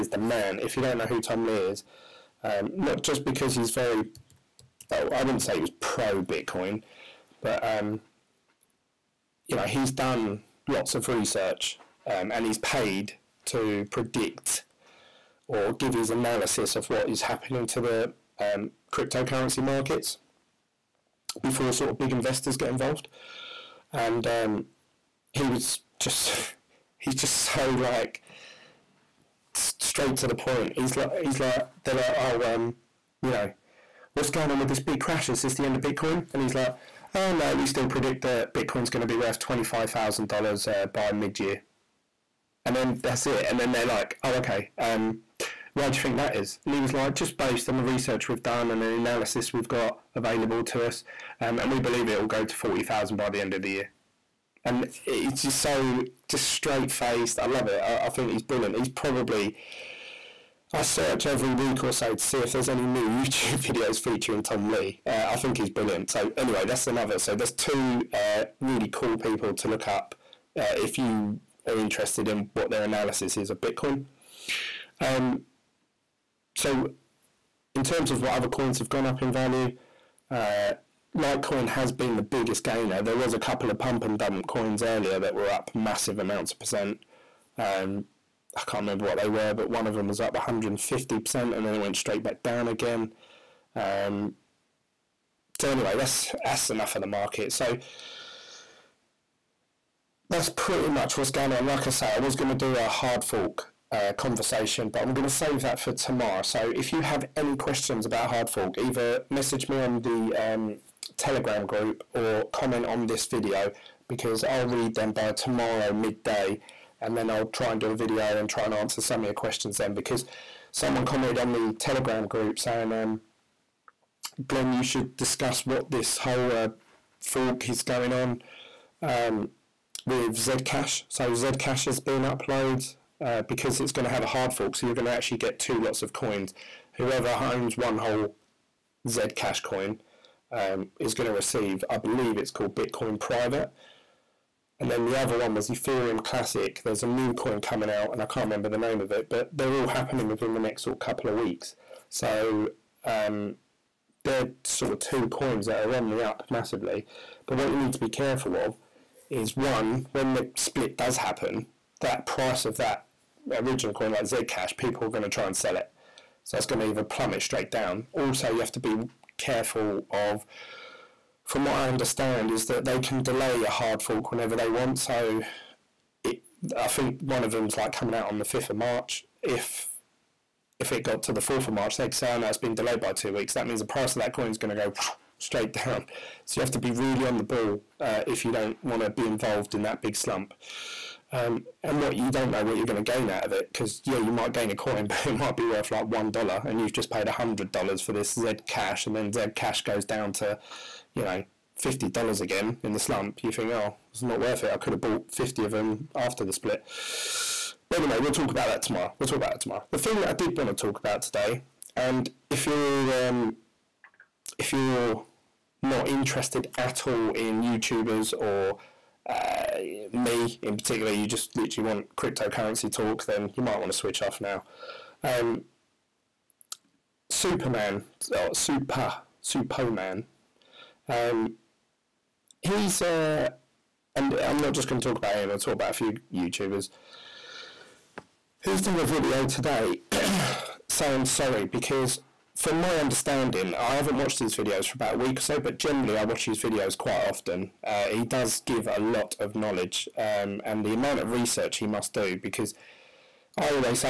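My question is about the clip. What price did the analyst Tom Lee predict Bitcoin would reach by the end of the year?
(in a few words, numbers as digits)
$40,000.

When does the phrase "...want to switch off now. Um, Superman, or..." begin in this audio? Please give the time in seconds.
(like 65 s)
223 s.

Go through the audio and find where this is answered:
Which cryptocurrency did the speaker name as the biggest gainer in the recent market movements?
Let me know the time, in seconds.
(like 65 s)
81 s.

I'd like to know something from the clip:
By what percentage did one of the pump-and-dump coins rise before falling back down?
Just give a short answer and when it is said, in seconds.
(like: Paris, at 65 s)
150%, at 90 s.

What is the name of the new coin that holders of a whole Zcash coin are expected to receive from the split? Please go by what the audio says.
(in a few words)
Bitcoin Private.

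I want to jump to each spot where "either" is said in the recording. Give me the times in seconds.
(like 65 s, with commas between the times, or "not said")
108 s, 166 s.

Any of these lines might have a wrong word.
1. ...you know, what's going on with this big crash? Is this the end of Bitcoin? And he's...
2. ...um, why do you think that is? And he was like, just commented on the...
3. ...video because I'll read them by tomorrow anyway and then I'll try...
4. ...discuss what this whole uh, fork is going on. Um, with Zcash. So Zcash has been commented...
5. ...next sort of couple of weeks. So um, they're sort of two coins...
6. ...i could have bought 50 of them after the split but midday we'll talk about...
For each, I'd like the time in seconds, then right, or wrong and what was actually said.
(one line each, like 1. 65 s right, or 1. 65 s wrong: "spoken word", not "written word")
1. 33 s right
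2. 44 s wrong: "based", not "commented"
3. 113 s wrong: "midday", not "anyway"
4. 125 s wrong: "uploaded", not "commented"
5. 150 s right
6. 204 s wrong: "anyway", not "midday".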